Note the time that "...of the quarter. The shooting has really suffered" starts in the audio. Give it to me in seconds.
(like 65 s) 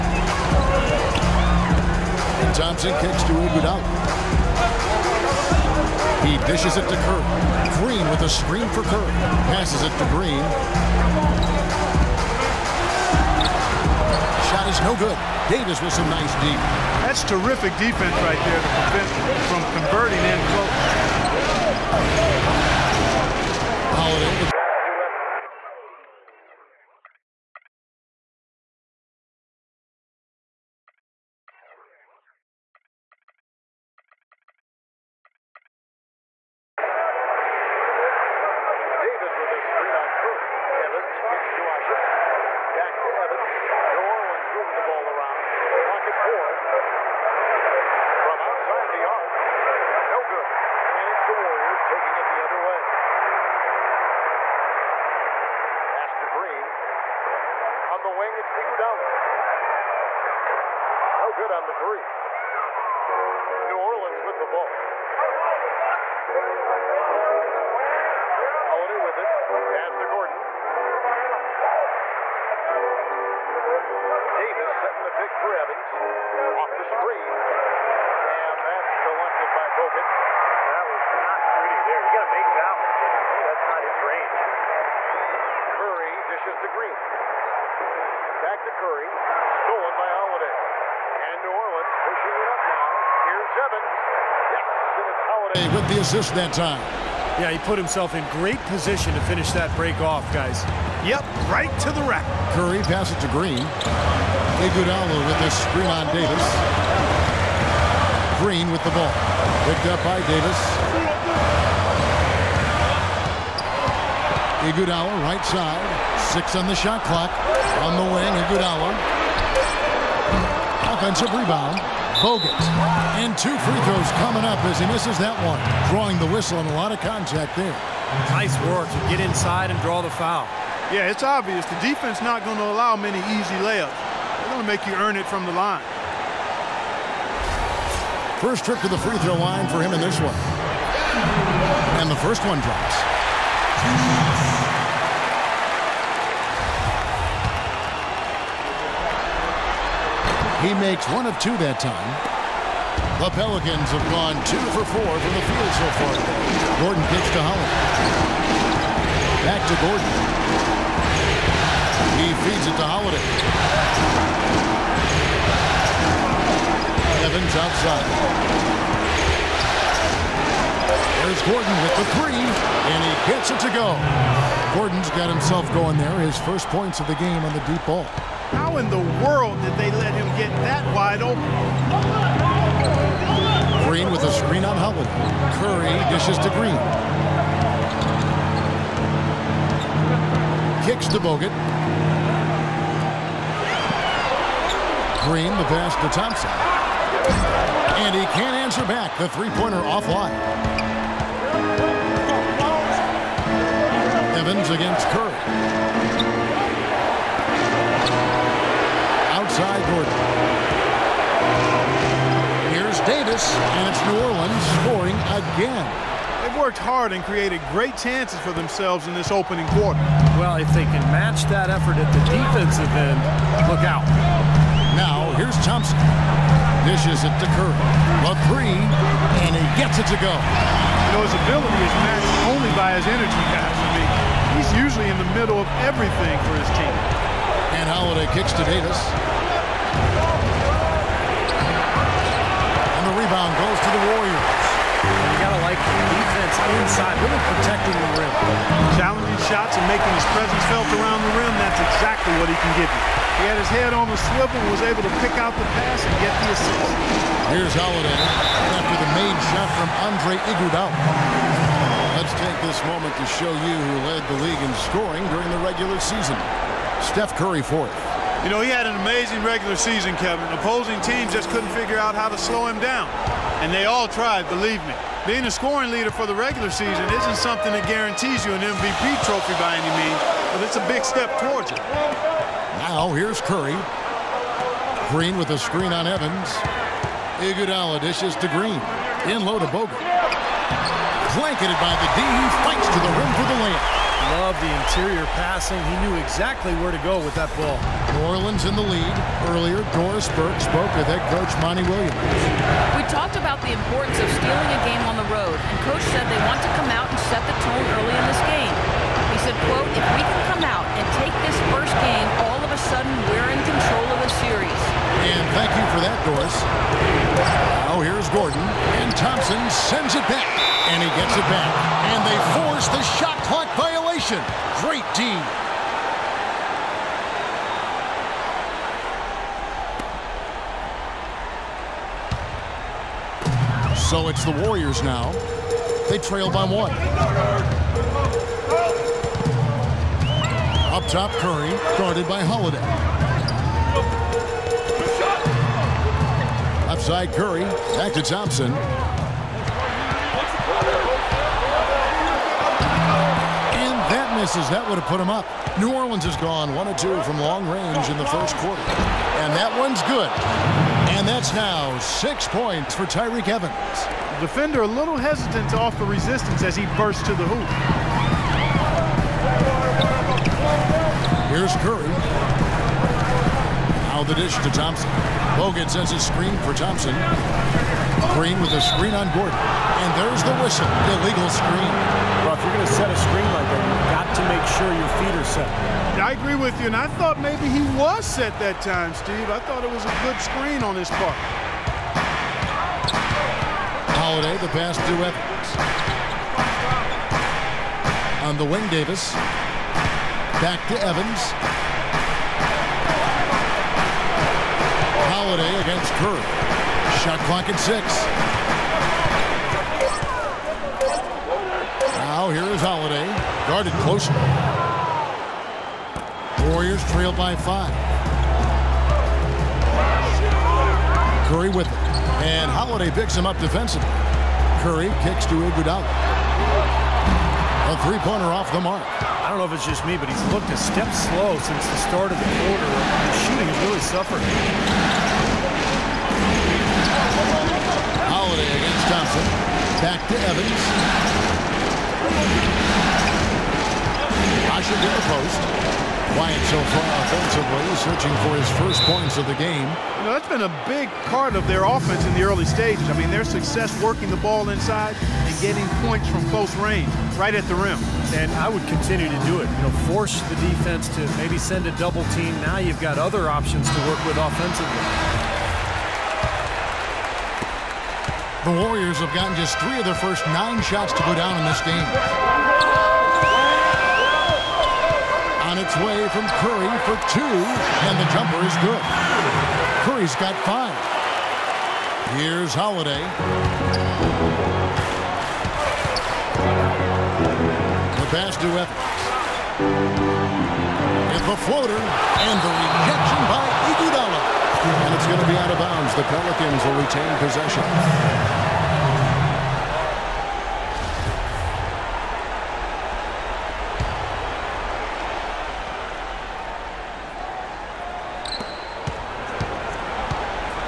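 432 s.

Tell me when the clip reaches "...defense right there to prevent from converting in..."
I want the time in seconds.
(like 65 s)
17 s.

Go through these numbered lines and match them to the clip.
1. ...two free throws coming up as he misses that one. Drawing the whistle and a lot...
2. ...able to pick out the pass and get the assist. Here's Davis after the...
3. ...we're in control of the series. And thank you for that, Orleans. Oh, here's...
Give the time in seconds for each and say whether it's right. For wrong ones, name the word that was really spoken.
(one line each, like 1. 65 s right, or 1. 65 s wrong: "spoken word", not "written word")
1. 123 s right
2. 254 s wrong: "Holiday", not "Davis"
3. 313 s wrong: "Doris", not "Orleans".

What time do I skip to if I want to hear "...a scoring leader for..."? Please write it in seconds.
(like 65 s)
275 s.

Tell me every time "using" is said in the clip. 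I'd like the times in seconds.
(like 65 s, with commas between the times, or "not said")
not said.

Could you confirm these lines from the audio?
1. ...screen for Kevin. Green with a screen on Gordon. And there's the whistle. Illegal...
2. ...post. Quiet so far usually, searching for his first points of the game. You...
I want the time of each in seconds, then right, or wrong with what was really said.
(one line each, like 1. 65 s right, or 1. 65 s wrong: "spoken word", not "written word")
1. 376 s wrong: "Thompson", not "Kevin"
2. 445 s wrong: "offensively", not "usually".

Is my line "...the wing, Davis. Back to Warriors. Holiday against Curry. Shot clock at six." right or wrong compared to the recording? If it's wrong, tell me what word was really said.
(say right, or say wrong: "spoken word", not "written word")
wrong: "Evans", not "Warriors".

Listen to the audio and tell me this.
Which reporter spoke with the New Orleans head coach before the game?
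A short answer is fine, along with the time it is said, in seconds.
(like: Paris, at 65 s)
Doris Burke, at 299 s.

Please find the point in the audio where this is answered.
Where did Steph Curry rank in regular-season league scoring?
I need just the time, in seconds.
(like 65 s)
267 s.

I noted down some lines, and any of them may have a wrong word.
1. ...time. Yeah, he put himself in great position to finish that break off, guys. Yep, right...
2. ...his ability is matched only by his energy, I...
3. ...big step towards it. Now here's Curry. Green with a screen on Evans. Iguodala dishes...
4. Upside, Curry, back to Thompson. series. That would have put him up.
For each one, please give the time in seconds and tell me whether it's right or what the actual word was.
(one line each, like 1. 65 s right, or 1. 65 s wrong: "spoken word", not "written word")
1. 96 s right
2. 231 s right
3. 280 s right
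4. 346 s wrong: "misses", not "series".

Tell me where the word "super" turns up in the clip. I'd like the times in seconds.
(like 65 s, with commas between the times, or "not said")
not said.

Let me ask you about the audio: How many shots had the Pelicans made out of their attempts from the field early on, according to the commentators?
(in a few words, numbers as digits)
2 for 4.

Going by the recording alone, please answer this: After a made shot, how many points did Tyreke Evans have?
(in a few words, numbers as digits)
6.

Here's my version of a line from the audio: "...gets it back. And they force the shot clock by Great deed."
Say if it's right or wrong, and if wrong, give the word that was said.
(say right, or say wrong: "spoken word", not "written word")
right.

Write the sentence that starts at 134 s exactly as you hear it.
They're going to make you earn it from the line.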